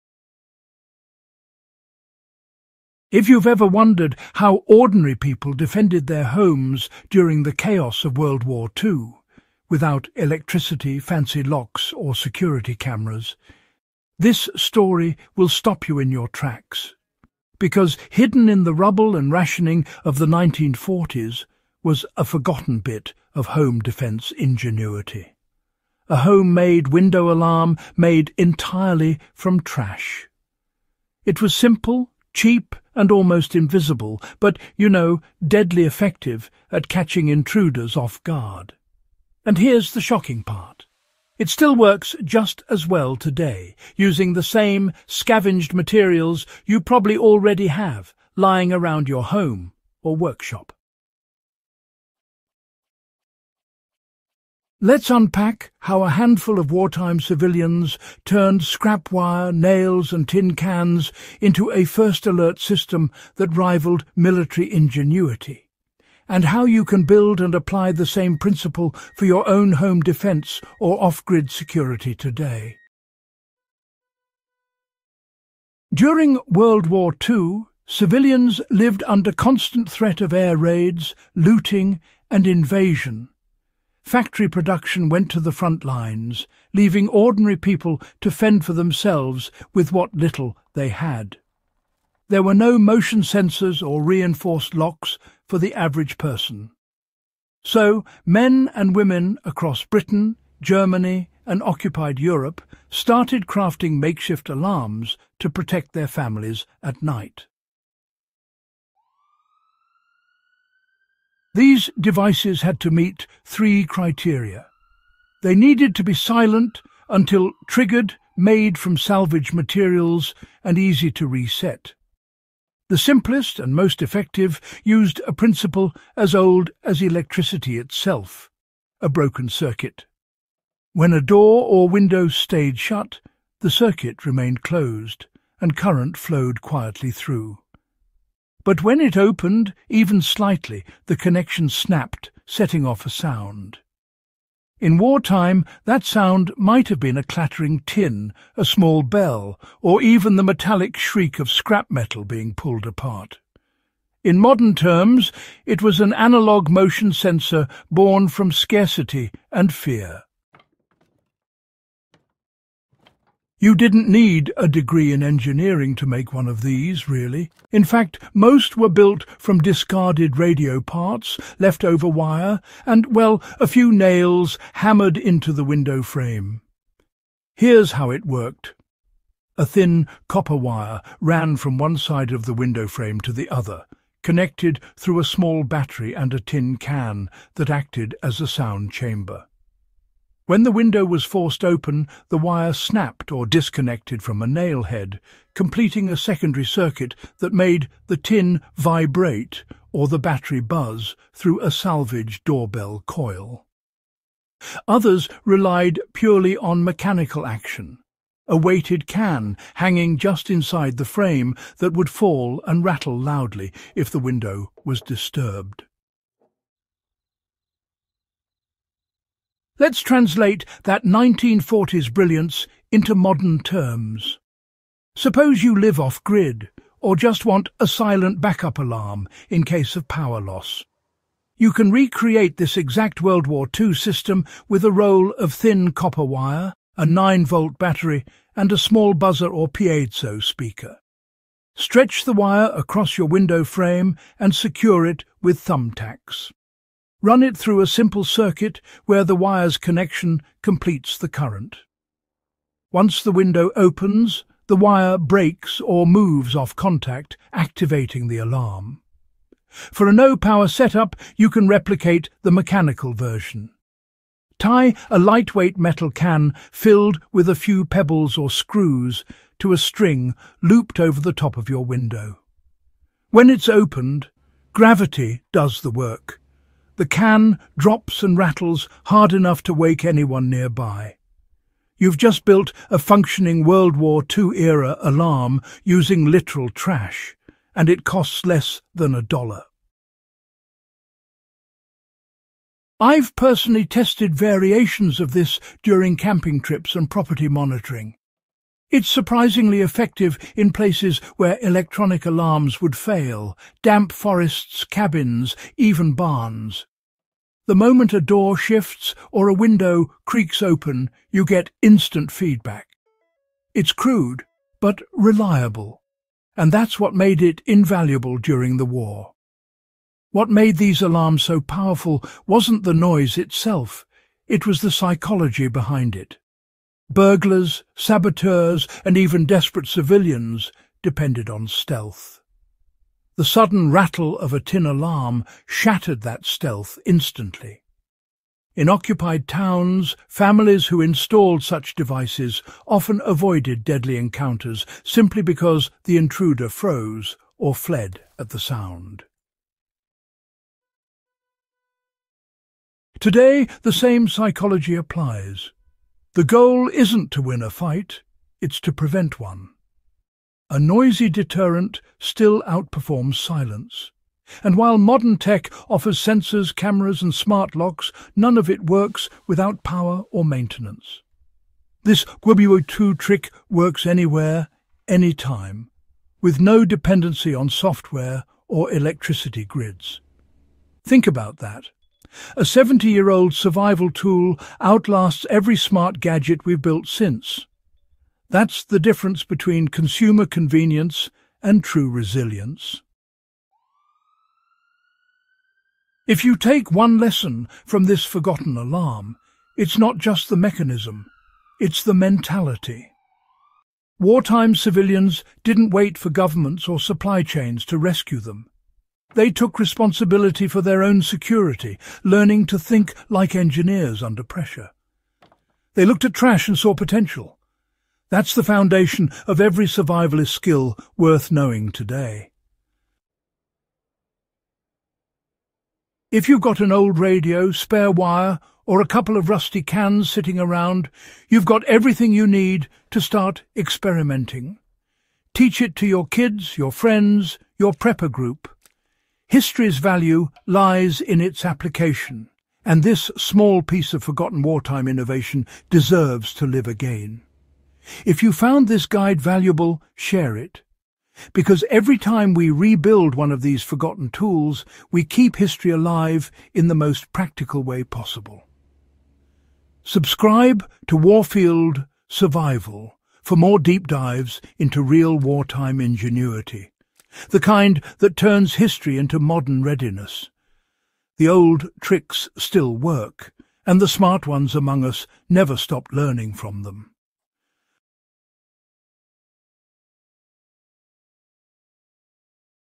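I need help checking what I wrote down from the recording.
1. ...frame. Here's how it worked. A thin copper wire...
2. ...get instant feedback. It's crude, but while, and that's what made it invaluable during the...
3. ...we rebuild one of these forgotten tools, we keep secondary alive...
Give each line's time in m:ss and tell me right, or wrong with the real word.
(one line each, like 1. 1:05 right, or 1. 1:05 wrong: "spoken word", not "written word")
1. 2:56 right
2. 5:11 wrong: "reliable", not "while"
3. 7:32 wrong: "history", not "secondary".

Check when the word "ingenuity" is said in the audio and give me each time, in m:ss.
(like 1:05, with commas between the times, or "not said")
0:24, 1:04, 7:45.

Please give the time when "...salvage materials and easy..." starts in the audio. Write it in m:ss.
1:58.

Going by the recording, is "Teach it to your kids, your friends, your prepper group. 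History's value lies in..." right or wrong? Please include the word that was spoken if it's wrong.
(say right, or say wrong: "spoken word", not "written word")
right.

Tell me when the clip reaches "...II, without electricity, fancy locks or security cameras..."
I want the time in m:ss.
0:08.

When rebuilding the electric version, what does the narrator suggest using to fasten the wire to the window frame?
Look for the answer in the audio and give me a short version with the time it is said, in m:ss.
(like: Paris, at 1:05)
thumbtacks, at 4:05.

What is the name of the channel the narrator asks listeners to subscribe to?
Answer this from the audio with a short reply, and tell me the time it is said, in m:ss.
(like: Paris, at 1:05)
Warfield Survival, at 7:41.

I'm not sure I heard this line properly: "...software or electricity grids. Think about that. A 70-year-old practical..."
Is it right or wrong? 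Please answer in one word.
wrong.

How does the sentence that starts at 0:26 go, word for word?
A homemade window alarm made entirely from trash.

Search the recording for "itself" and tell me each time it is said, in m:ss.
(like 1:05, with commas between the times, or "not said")
2:07, 5:23.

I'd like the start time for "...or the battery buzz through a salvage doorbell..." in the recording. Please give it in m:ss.
3:19.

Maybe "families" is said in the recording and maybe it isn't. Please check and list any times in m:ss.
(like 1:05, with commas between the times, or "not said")
1:46, 5:40.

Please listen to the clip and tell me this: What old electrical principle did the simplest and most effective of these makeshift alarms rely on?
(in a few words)
a broken circuit.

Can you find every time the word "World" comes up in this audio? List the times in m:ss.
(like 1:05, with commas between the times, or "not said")
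0:08, 1:16, 3:53, 4:43.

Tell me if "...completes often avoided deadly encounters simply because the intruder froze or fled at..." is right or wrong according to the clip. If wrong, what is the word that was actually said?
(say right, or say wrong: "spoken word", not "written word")
wrong: "devices", not "completes".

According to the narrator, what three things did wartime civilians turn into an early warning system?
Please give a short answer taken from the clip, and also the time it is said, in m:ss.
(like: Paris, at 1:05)
scrap wire, nails and tin cans, at 0:58.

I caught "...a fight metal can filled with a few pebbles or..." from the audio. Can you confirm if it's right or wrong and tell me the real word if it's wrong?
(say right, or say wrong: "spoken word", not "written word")
wrong: "lightweight", not "fight".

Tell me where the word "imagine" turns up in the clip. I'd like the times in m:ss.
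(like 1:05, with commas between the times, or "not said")
not said.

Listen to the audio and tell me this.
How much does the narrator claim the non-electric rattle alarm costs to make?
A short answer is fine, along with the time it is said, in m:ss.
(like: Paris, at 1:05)
less than a dollar, at 4:48.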